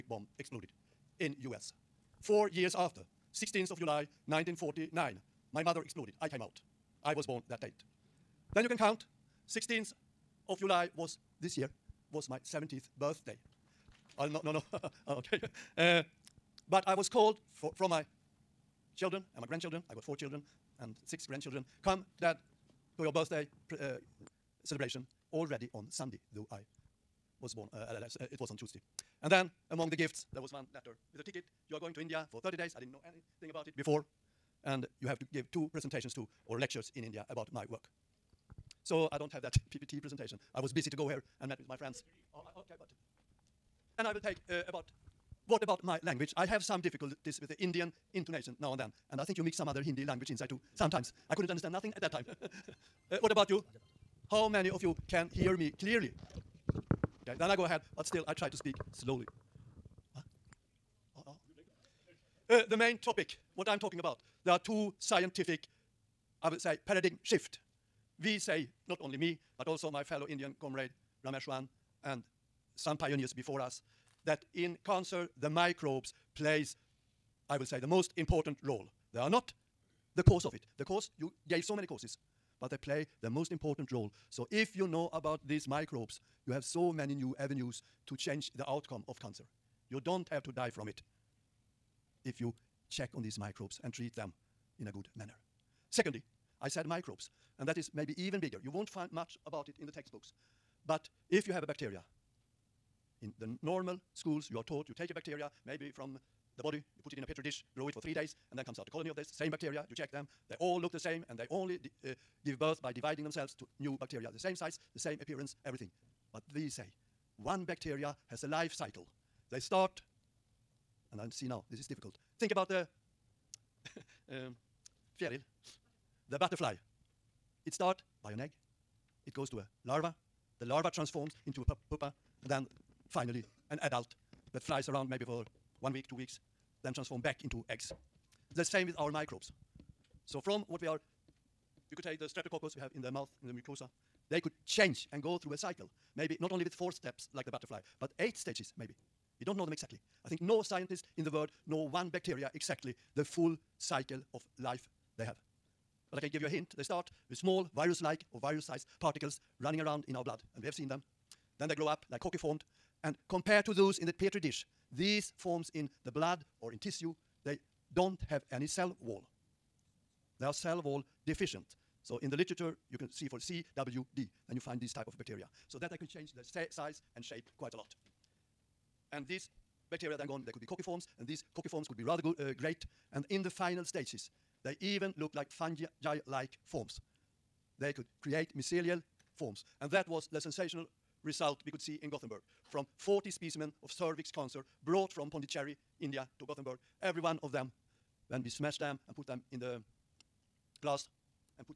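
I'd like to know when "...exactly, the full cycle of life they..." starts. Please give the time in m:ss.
2:32.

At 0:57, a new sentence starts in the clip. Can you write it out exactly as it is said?
Okay, then I go ahead, but still I try to speak slowly.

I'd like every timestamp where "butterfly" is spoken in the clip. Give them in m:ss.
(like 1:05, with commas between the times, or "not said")
2:06, 2:27.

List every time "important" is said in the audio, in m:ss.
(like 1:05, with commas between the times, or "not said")
1:18, 1:23.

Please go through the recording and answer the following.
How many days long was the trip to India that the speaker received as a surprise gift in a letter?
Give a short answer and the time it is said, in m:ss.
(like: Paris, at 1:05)
30, at 0:32.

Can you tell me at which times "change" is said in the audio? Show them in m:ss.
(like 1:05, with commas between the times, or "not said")
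1:28, 2:24, 2:56.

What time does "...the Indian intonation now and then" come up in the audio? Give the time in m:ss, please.
0:47.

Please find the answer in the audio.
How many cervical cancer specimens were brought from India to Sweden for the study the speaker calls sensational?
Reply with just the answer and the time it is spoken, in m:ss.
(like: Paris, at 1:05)
40, at 3:12.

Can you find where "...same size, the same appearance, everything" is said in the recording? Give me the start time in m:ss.
1:54.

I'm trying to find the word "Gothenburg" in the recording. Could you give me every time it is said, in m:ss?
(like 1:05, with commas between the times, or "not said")
3:12, 3:16.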